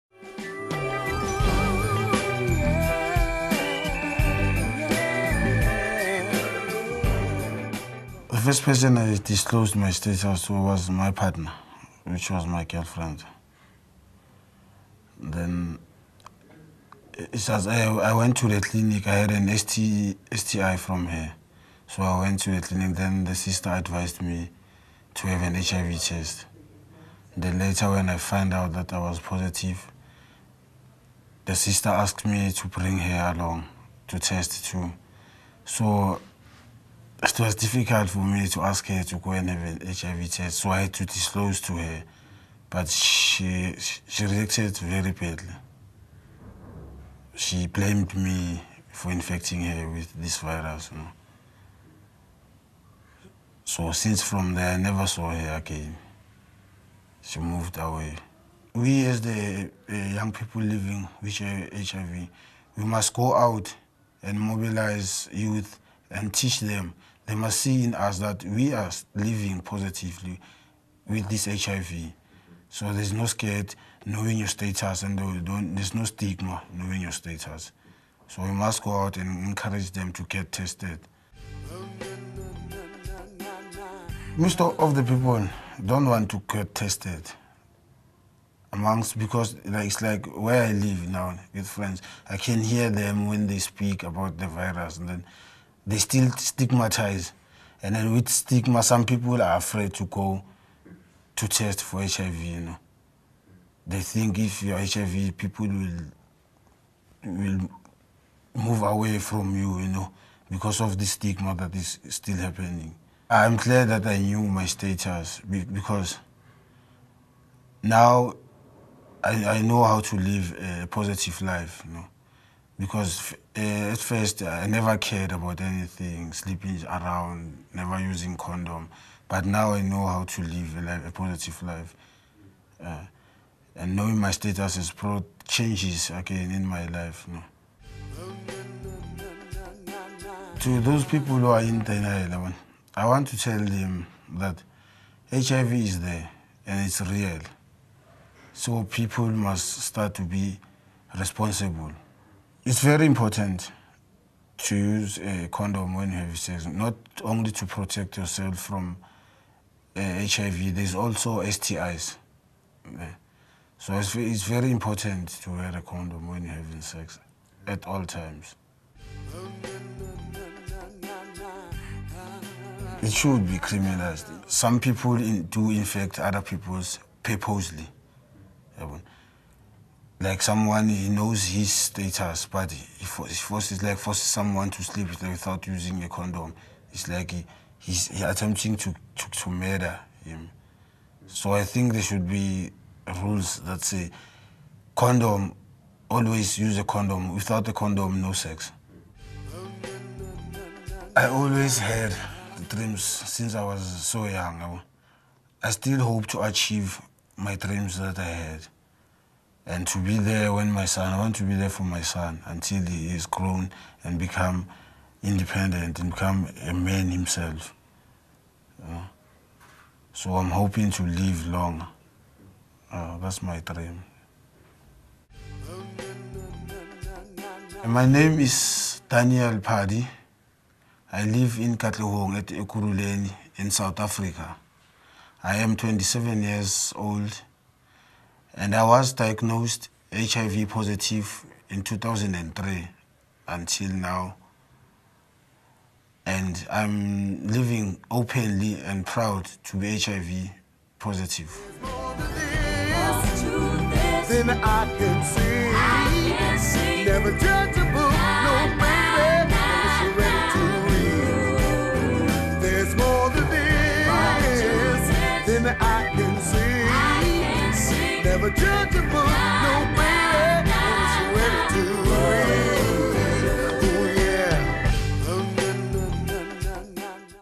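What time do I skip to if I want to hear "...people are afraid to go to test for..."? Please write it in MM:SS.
01:39.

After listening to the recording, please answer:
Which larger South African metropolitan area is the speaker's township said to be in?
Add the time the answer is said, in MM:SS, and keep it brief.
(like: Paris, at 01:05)
Ekurhuleni, at 03:52.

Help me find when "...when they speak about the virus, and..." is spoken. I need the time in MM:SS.
01:33.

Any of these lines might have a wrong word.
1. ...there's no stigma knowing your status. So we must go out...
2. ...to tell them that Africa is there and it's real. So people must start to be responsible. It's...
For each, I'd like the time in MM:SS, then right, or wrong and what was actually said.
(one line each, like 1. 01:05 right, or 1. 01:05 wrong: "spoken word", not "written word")
1. 01:15 right
2. 02:23 wrong: "HIV", not "Africa".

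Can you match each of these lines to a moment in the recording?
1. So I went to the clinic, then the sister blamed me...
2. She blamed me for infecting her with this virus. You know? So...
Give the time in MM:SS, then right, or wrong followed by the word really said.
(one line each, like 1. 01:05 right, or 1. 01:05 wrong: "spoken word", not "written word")
1. 00:21 wrong: "advised", not "blamed"
2. 00:47 right.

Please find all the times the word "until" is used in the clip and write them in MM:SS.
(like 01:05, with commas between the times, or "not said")
03:32, 04:03.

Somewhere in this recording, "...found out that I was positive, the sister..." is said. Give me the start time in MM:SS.
00:28.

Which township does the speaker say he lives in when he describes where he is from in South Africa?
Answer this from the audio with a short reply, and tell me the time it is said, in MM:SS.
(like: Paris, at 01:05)
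Katlehong, at 03:51.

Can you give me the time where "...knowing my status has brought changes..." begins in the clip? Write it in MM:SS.
02:13.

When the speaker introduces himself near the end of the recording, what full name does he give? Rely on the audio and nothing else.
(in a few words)
Daniel Padi.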